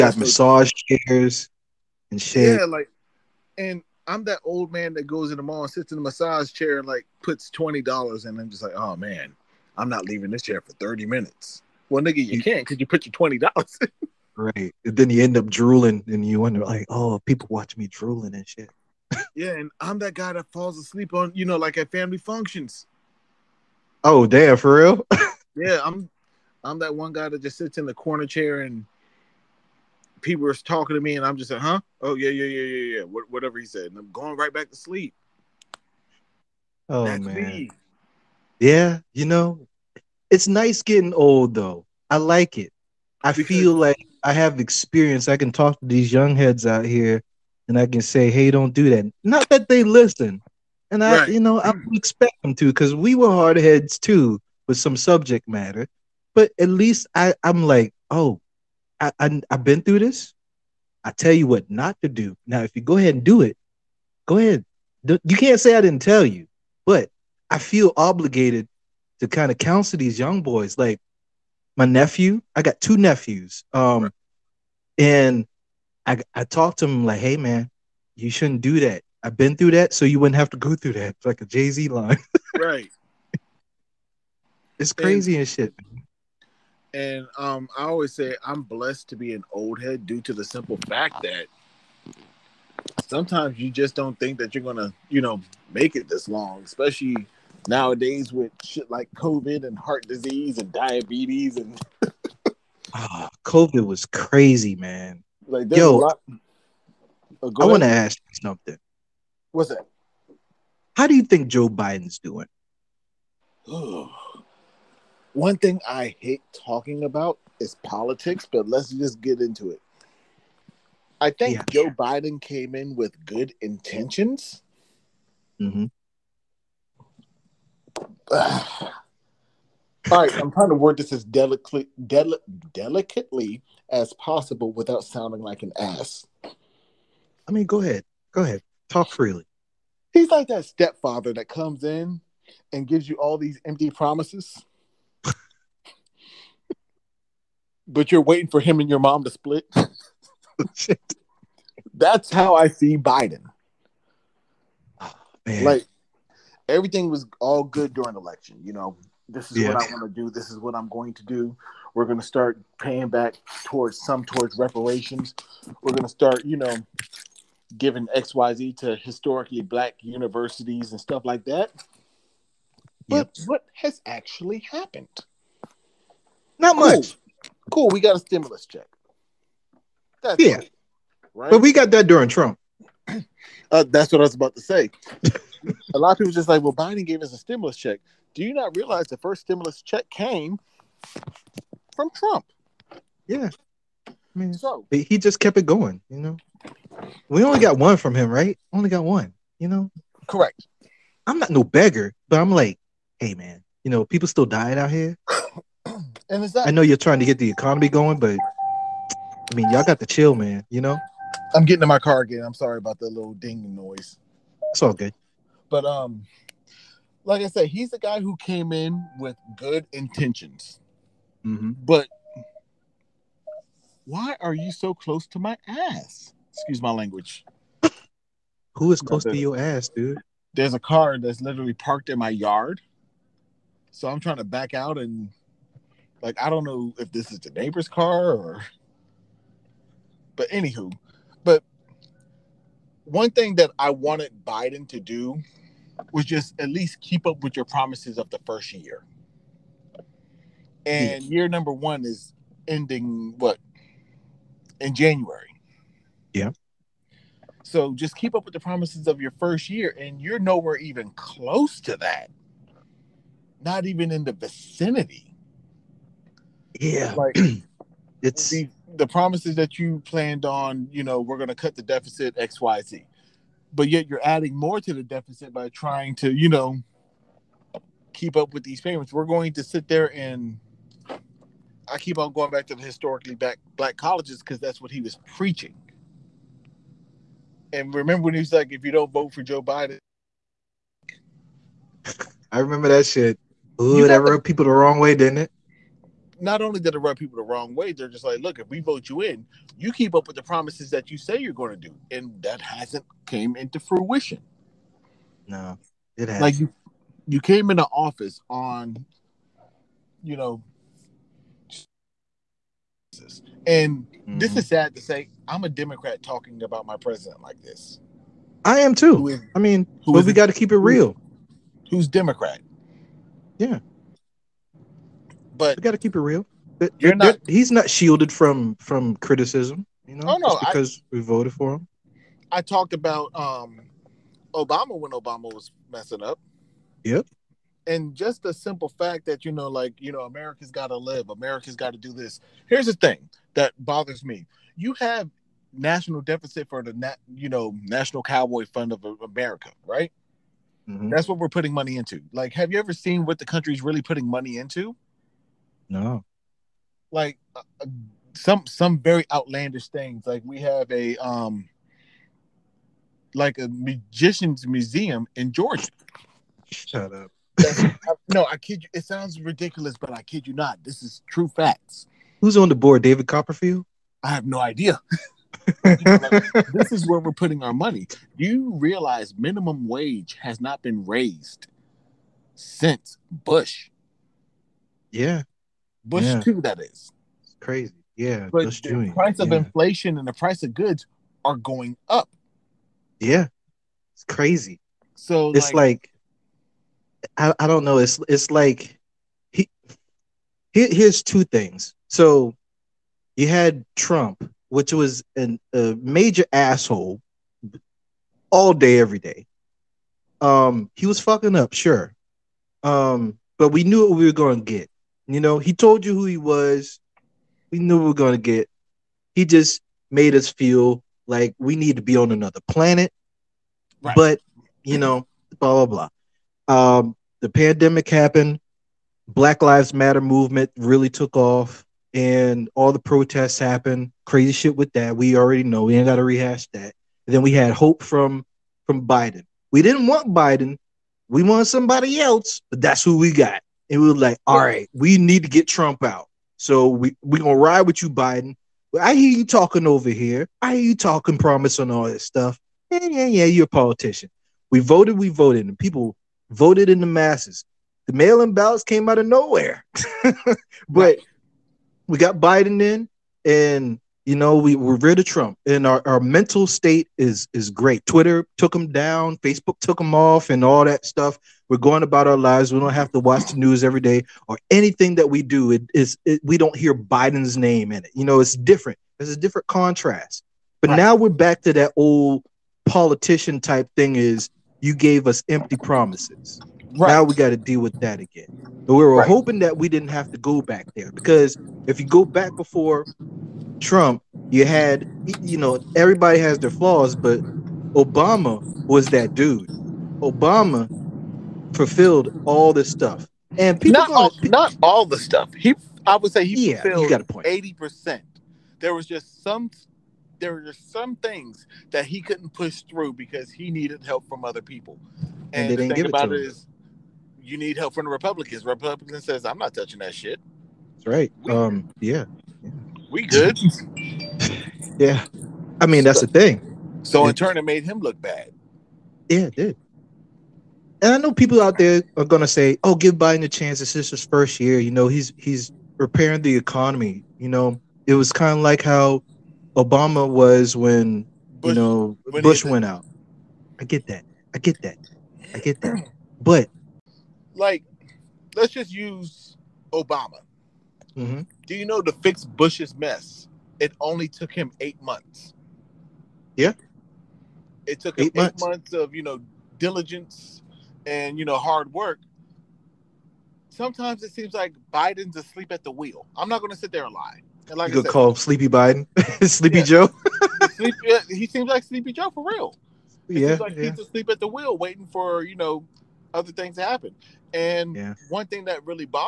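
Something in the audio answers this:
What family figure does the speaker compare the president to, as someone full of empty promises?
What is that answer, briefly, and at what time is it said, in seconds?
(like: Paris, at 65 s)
stepfather, at 140 s.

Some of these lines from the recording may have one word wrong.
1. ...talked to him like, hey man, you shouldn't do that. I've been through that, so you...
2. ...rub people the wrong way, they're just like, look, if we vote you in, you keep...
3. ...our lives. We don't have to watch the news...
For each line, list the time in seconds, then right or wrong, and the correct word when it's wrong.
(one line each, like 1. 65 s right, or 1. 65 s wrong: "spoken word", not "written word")
1. 76 s right
2. 296 s right
3. 472 s right.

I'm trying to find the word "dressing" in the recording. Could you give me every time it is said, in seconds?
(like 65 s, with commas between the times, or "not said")
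not said.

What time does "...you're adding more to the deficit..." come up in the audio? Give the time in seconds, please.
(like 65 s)
274 s.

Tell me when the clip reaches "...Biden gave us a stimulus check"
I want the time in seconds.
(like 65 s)
186 s.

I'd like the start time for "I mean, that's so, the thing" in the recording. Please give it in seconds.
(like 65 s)
525 s.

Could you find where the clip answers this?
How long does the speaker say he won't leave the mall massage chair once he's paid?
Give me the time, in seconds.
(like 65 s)
10 s.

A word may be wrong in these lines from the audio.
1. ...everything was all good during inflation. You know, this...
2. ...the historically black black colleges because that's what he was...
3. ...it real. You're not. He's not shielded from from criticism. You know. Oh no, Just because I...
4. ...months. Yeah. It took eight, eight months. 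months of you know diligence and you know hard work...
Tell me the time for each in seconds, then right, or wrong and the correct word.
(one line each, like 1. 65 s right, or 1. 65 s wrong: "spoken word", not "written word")
1. 156 s wrong: "election", not "inflation"
2. 282 s right
3. 326 s right
4. 555 s right.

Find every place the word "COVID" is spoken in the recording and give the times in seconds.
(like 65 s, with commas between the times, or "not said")
99 s, 103 s.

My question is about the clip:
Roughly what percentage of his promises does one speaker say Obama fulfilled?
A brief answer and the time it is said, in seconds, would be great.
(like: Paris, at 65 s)
80%, at 507 s.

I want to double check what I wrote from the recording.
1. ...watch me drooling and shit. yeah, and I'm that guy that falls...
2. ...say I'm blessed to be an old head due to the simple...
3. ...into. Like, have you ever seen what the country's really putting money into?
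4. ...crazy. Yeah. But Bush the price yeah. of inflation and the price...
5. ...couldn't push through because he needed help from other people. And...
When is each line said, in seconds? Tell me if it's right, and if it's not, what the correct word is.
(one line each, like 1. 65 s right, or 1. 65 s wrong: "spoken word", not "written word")
1. 17 s right
2. 88 s right
3. 351 s right
4. 387 s right
5. 512 s right.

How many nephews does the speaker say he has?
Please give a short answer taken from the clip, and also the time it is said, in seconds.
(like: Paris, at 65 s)
2, at 72 s.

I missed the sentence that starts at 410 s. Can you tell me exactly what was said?
Um, he was fucking up, sure.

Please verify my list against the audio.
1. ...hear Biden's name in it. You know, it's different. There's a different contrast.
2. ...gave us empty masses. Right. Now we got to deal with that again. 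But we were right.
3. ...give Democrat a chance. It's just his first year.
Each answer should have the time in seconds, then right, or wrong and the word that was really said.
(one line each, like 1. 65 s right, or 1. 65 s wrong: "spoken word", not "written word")
1. 476 s right
2. 484 s wrong: "promises", not "masses"
3. 532 s wrong: "Biden", not "Democrat".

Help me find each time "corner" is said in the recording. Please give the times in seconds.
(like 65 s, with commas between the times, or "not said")
27 s.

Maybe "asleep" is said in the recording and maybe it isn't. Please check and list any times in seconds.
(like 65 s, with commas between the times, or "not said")
20 s, 565 s, 573 s.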